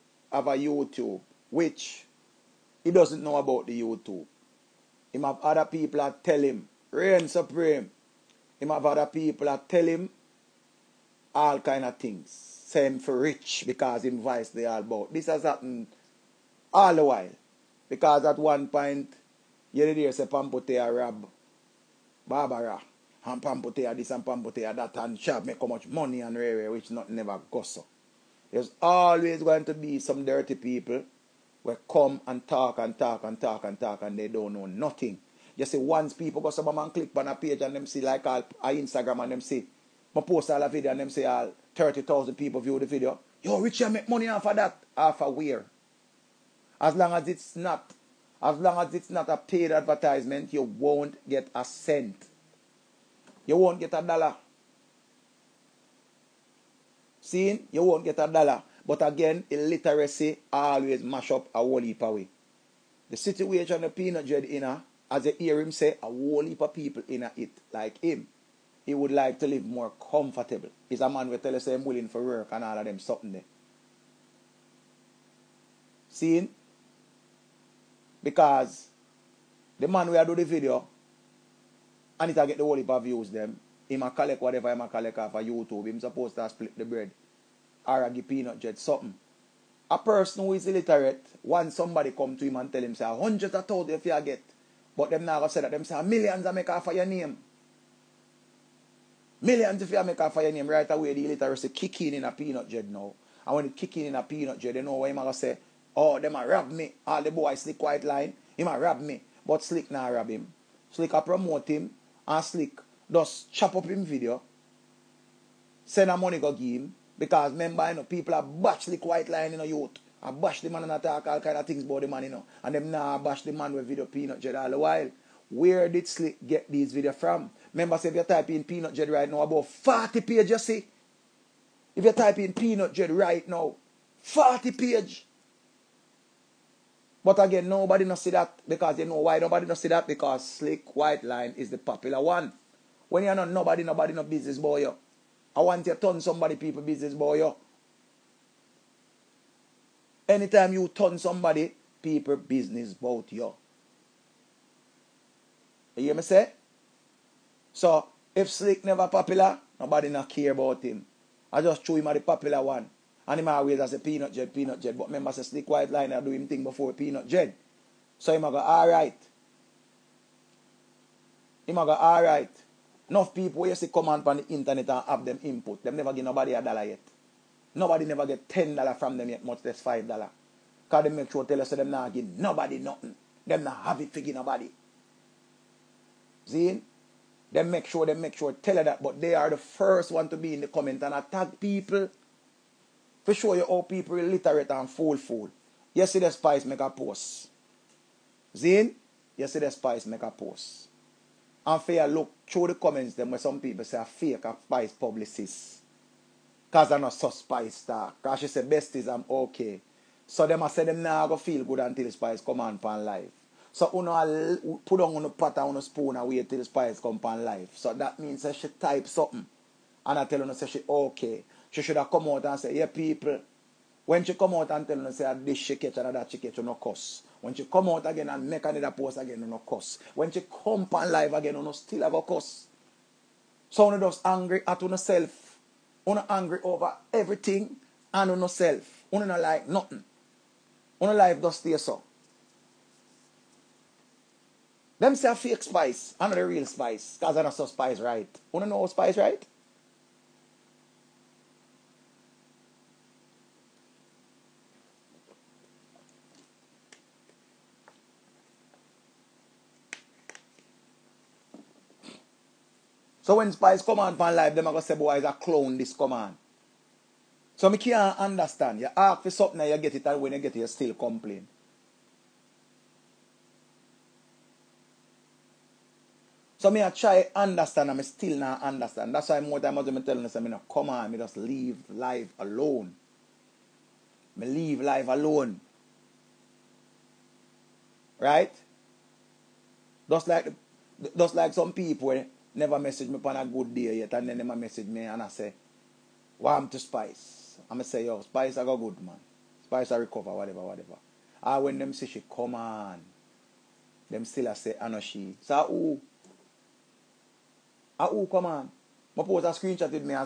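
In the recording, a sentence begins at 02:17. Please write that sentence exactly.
But again, nobody not see that because they know why nobody not see that because slick white line is the popular one.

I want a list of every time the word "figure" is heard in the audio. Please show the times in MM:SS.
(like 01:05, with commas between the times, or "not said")
03:04.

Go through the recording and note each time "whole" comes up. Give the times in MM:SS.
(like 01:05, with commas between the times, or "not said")
01:01, 01:06, 01:22.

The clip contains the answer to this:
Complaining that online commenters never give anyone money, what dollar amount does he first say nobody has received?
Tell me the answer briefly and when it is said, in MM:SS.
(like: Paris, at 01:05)
10 dollars, at 02:58.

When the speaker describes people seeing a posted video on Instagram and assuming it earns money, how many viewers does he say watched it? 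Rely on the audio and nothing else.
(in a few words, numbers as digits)
30,000.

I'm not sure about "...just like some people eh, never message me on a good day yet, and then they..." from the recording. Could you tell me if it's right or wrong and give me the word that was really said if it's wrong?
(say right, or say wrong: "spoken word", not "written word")
right.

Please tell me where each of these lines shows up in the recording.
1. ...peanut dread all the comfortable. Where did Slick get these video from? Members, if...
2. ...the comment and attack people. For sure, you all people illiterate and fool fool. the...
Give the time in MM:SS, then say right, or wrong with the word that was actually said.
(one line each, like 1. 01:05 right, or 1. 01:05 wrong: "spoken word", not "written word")
1. 02:04 wrong: "while", not "comfortable"
2. 03:10 right.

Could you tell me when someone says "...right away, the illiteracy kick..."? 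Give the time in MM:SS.
01:40.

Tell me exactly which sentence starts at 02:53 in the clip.
Enough people you see come on the internet and have them input.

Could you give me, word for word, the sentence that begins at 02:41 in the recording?
I just threw him at the popular one.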